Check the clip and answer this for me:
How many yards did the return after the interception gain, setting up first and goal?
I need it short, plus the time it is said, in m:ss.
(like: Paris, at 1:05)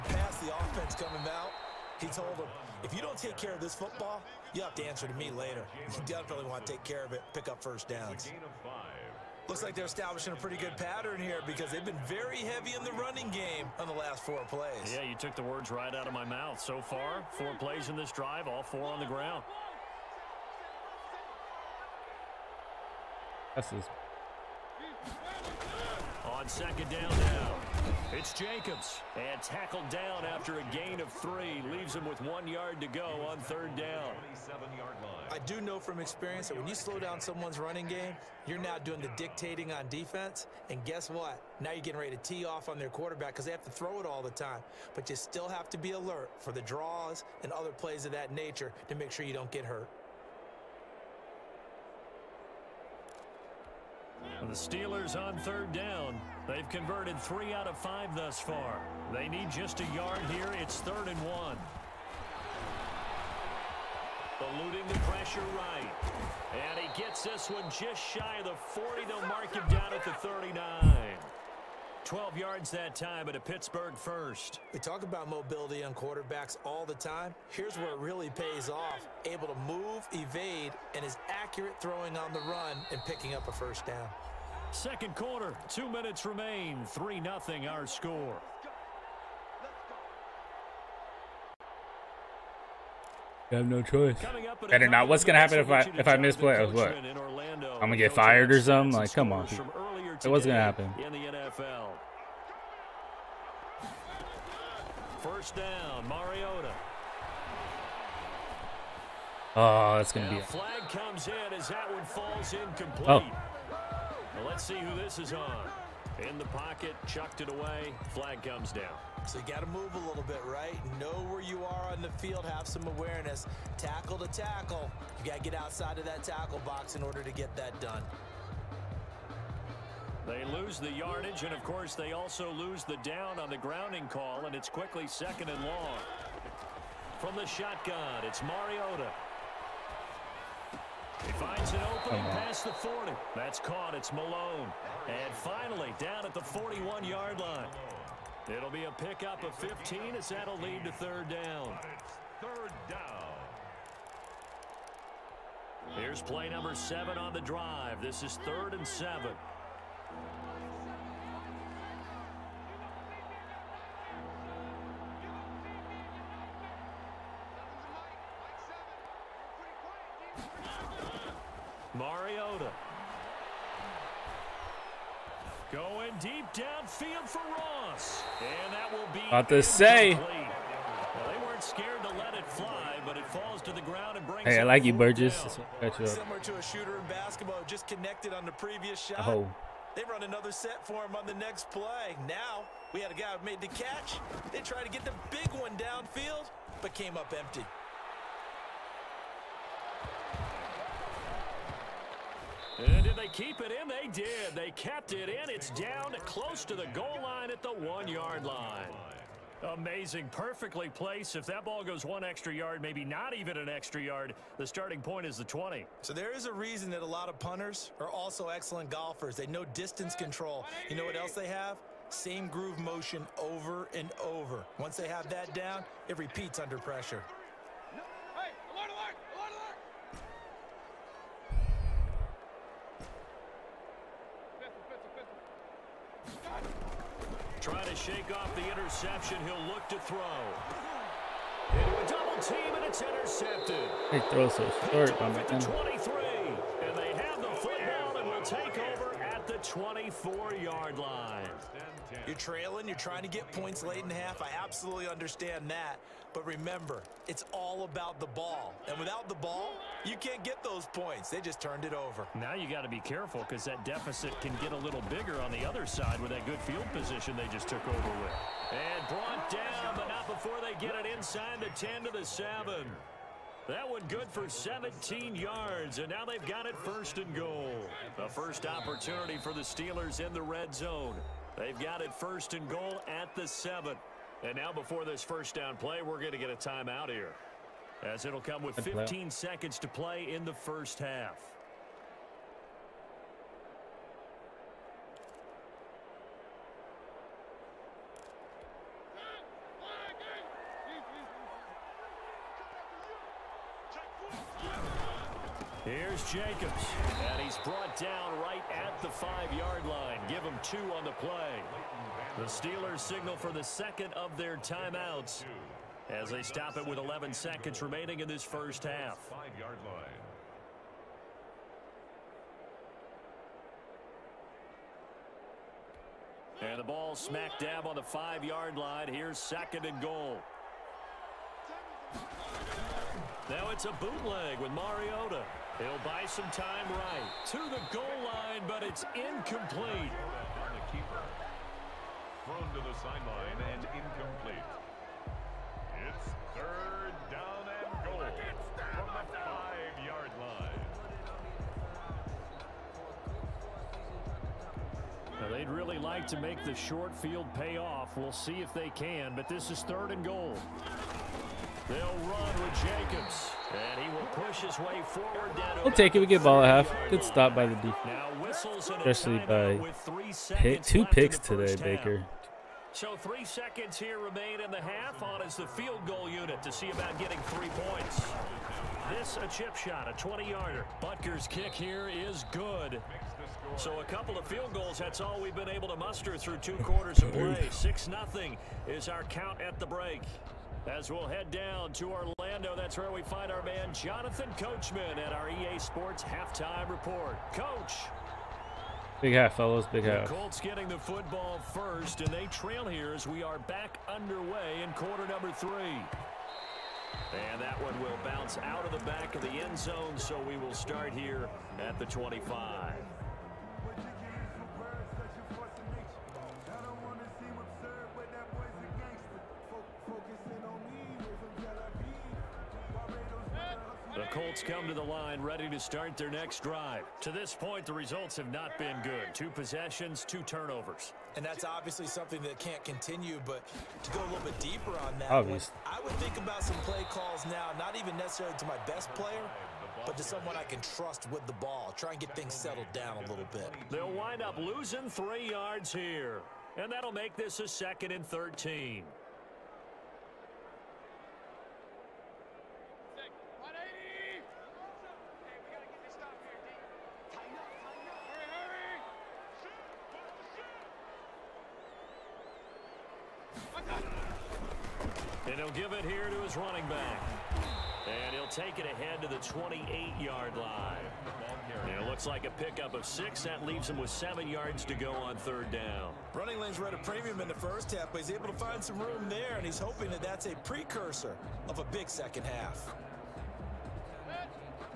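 17, at 4:33.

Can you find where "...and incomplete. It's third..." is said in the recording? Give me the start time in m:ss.
5:43.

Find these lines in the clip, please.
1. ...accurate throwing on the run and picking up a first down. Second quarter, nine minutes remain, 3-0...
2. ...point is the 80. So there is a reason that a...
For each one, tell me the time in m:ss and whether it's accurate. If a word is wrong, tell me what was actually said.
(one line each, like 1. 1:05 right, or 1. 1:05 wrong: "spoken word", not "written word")
1. 1:21 wrong: "two", not "nine"
2. 3:35 wrong: "20", not "80".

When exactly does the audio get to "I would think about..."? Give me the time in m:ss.
7:15.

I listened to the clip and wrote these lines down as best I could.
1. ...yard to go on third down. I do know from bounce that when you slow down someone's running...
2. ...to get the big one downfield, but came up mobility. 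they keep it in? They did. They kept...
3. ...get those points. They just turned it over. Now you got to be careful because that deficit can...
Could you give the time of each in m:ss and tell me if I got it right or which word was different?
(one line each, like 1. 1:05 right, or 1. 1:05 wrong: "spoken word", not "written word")
1. 0:32 wrong: "experience", not "bounce"
2. 3:14 wrong: "empty", not "mobility"
3. 4:20 right.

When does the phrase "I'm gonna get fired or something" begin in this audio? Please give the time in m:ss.
1:36.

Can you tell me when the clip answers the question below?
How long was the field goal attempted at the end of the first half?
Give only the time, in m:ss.
6:20.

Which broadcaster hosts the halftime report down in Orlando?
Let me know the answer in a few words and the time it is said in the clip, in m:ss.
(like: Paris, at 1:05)
Jonathan Coachman, at 6:33.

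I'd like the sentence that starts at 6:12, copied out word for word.
So three seconds here remain in the half.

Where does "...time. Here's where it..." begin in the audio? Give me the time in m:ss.
1:16.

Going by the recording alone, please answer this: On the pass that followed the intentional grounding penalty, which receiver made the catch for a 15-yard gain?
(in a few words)
Malone.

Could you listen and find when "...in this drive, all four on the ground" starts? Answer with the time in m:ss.
0:17.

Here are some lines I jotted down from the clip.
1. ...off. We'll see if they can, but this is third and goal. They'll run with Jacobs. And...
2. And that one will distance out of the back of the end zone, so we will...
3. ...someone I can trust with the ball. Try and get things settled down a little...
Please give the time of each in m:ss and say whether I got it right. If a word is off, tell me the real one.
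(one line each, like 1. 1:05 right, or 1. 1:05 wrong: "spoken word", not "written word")
1. 5:57 right
2. 6:47 wrong: "bounce", not "distance"
3. 7:20 right.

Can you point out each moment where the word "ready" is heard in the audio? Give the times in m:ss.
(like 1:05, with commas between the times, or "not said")
0:41, 7:05.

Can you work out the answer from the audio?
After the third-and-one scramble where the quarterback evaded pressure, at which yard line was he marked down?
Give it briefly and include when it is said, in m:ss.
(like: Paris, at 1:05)
39, at 1:09.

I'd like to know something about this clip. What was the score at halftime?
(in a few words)
6-0.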